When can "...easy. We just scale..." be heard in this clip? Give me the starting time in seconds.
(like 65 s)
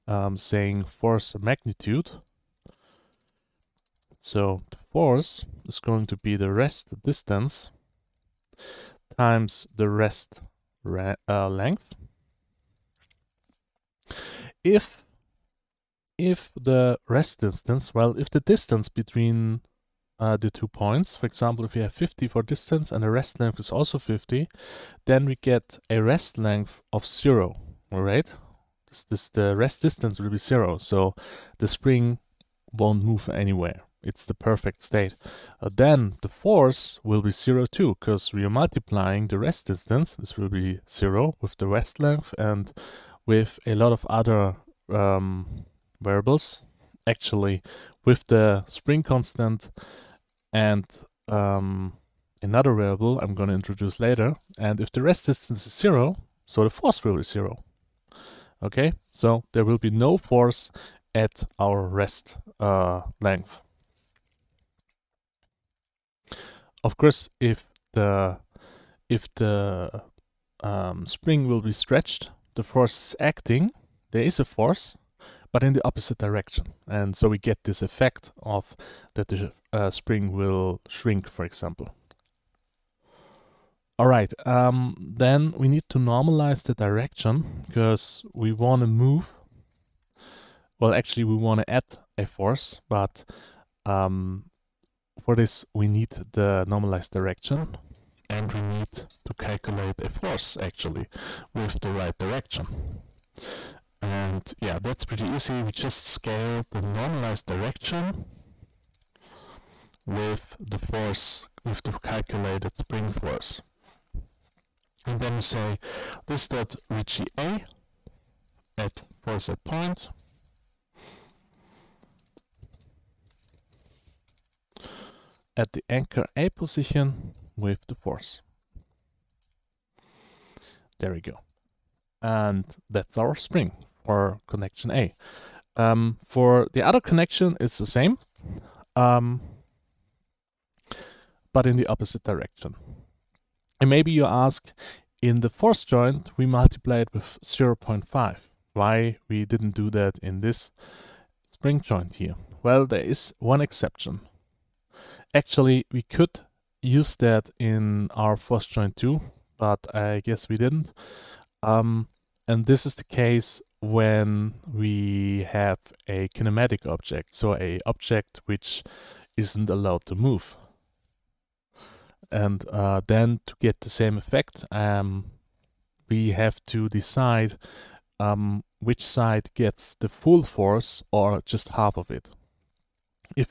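105 s.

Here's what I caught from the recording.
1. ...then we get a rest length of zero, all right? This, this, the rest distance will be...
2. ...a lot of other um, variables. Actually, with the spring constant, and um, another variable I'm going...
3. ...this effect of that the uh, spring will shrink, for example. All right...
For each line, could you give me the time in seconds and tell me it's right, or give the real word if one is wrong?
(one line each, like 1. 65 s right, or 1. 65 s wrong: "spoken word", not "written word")
1. 25 s right
2. 43 s right
3. 77 s right.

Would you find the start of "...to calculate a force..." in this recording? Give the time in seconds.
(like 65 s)
98 s.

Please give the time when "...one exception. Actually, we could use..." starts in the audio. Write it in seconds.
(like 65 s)
153 s.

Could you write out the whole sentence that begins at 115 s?
And then we say this dot Ricci A at force at point.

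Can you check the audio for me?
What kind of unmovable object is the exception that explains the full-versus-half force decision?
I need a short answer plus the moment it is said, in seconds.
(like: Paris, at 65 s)
kinematic object, at 166 s.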